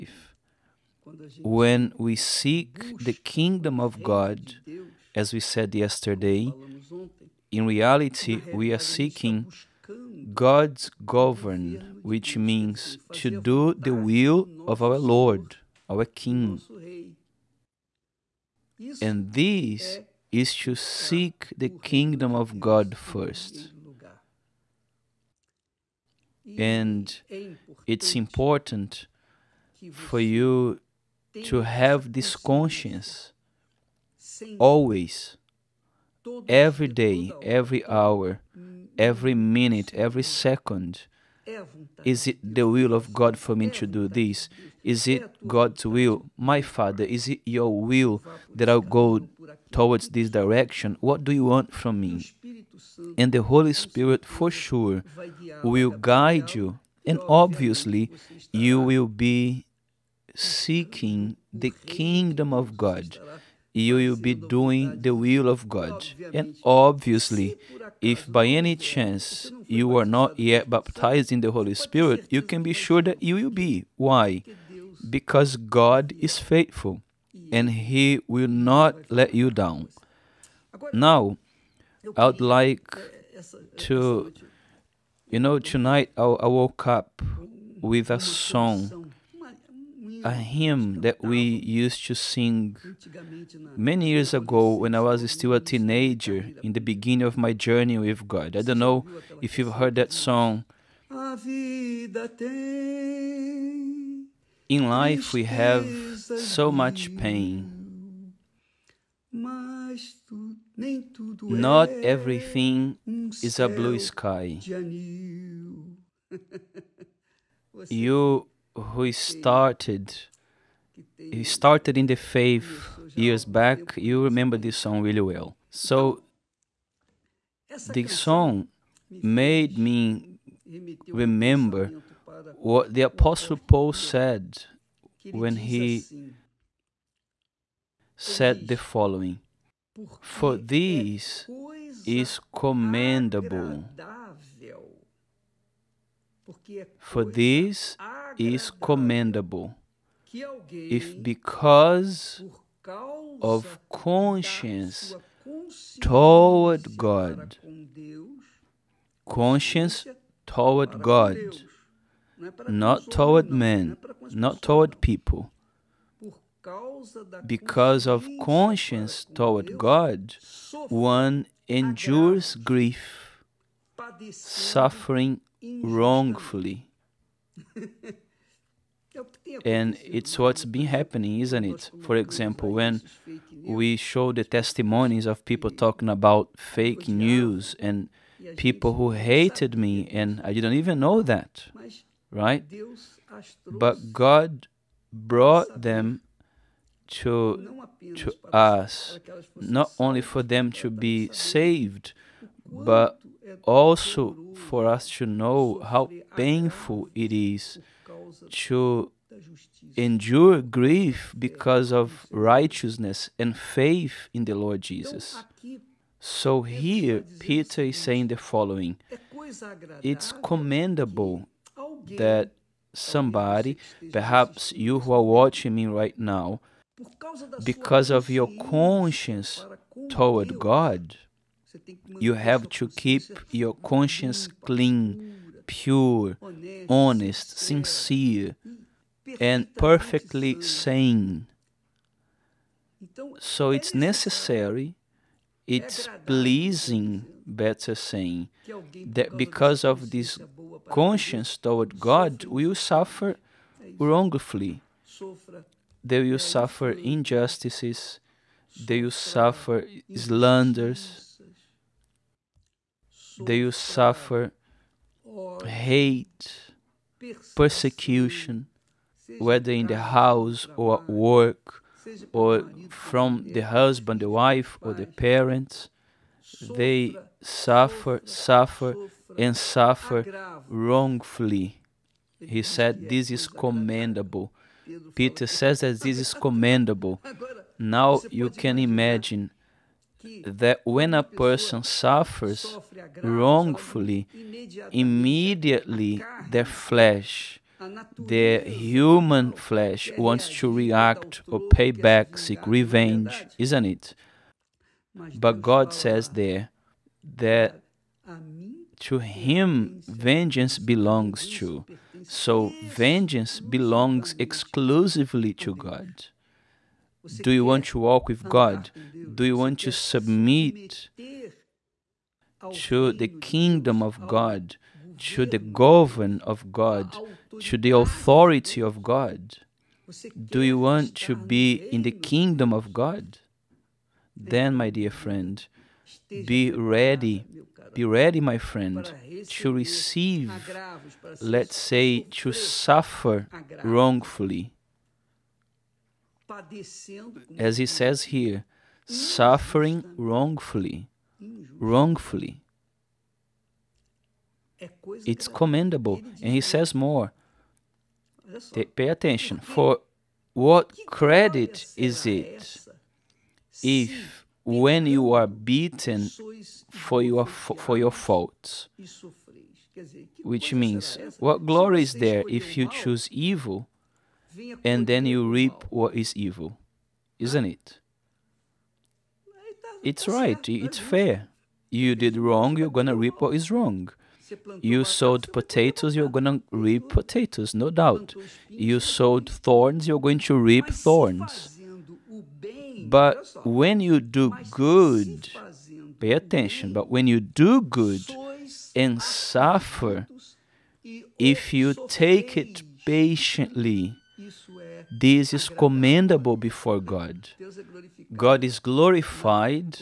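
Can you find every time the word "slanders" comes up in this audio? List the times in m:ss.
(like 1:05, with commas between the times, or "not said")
4:20.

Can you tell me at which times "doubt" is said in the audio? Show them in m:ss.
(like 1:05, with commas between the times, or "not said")
6:27.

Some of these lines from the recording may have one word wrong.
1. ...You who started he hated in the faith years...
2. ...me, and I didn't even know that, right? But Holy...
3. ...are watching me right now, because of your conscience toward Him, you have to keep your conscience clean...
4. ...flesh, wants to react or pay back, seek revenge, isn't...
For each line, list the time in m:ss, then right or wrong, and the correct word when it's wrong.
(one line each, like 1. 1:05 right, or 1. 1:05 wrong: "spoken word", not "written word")
1. 1:57 wrong: "started", not "hated"
2. 3:09 wrong: "God", not "Holy"
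3. 3:45 wrong: "God", not "Him"
4. 4:59 right.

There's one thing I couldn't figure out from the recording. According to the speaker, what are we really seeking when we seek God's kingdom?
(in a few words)
God's govern.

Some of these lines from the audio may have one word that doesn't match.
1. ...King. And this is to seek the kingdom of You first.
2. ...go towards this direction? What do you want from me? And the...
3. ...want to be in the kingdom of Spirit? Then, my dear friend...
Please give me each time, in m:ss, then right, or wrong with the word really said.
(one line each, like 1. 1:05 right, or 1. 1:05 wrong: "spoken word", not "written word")
1. 0:16 wrong: "God", not "You"
2. 0:48 right
3. 5:30 wrong: "God", not "Spirit".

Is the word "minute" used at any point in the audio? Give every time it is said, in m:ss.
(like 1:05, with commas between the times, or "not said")
0:39.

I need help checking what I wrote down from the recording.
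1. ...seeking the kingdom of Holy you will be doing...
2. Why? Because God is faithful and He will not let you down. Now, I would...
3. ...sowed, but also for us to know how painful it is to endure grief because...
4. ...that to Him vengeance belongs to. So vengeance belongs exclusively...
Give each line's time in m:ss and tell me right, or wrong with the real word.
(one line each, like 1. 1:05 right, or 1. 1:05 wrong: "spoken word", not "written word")
1. 1:00 wrong: "God", not "Holy"
2. 1:13 right
3. 3:21 wrong: "saved", not "sowed"
4. 5:07 right.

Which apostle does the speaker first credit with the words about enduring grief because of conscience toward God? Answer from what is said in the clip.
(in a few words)
Paul.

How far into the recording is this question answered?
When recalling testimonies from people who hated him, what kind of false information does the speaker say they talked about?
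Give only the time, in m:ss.
3:06.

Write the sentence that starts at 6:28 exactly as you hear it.
You sowed thorns, you're going to reap thorns.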